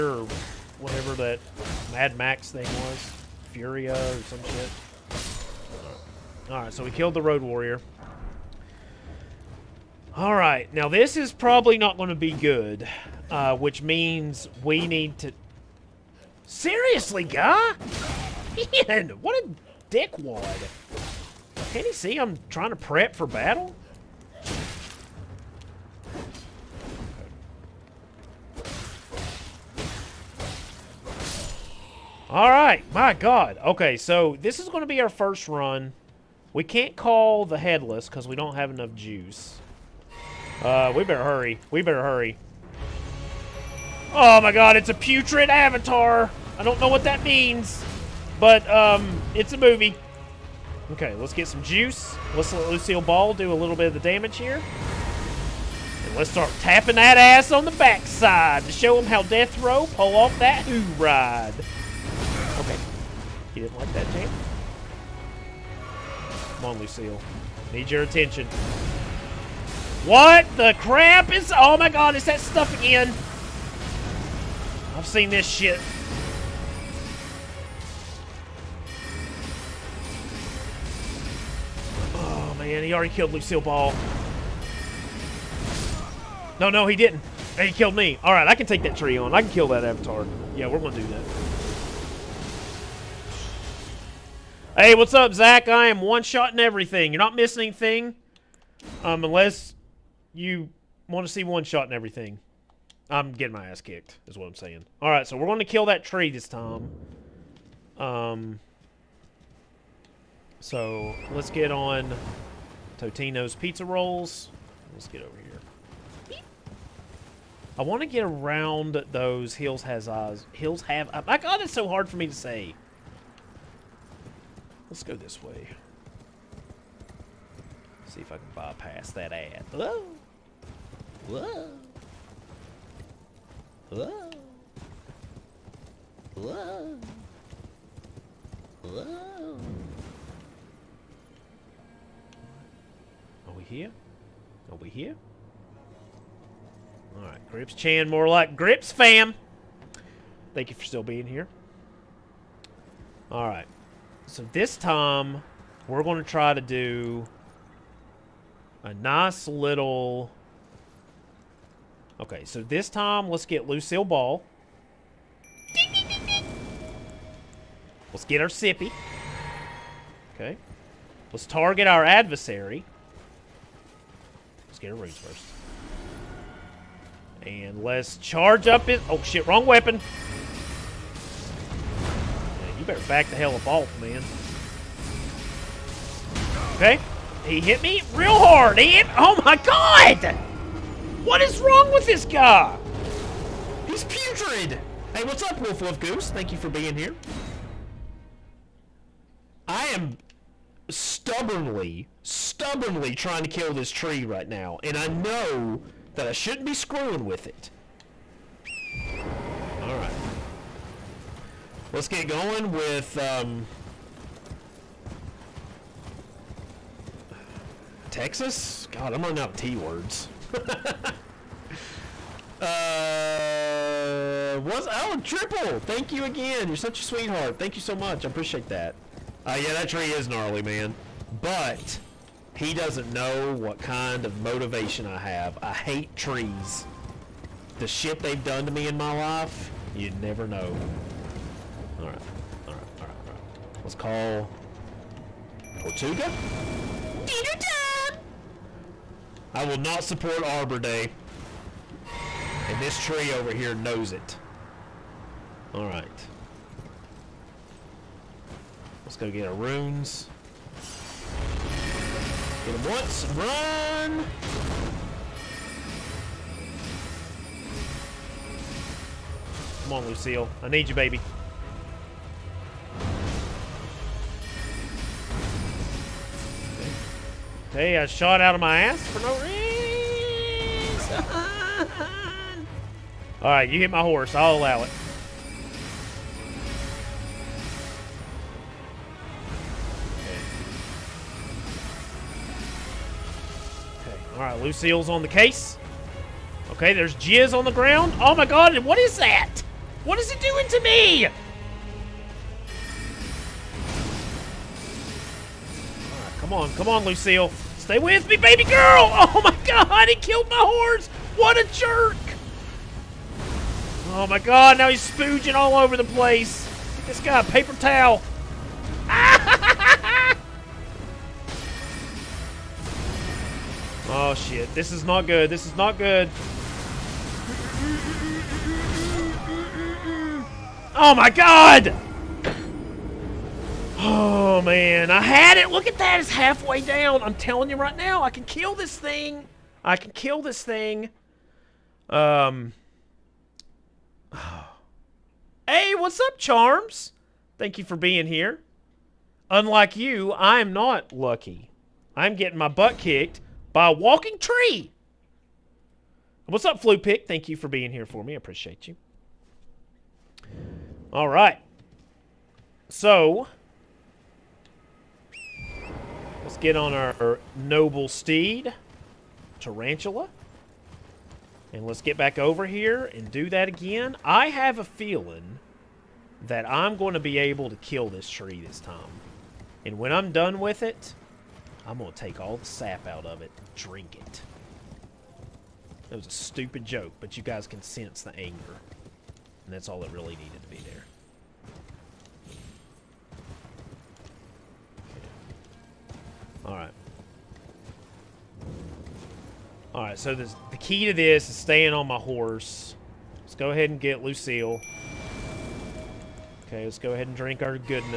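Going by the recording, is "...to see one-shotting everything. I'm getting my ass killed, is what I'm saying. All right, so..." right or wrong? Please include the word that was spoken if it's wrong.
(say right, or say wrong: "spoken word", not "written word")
wrong: "kicked", not "killed".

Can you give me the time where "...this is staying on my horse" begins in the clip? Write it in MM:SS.
06:41.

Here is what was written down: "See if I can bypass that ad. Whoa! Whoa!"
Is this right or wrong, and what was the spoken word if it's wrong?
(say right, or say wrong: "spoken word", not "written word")
right.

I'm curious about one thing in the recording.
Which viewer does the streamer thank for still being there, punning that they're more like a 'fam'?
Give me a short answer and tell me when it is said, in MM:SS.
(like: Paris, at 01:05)
Grips Chan, at 02:27.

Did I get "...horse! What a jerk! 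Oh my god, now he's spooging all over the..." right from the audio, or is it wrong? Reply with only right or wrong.
right.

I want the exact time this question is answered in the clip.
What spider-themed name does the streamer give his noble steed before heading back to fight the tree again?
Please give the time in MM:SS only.
06:09.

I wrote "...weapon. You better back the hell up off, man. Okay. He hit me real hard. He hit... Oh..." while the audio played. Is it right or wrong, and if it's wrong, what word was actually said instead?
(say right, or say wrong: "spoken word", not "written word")
right.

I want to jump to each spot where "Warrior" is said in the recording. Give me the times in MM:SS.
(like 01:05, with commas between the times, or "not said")
00:07.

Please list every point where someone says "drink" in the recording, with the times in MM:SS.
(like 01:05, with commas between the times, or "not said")
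06:23, 06:47.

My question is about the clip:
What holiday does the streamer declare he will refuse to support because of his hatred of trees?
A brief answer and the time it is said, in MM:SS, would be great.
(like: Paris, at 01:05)
Arbor Day, at 04:10.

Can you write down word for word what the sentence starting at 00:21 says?
Can you see I'm trying to prep for battle?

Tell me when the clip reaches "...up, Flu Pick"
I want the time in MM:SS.
05:56.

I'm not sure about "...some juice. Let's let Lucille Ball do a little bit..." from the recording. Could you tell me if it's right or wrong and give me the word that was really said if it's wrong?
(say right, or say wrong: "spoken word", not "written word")
right.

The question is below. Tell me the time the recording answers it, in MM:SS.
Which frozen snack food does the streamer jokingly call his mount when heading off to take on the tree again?
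01:52.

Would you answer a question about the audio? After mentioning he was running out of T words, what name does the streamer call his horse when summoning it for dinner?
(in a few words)
Tortuga.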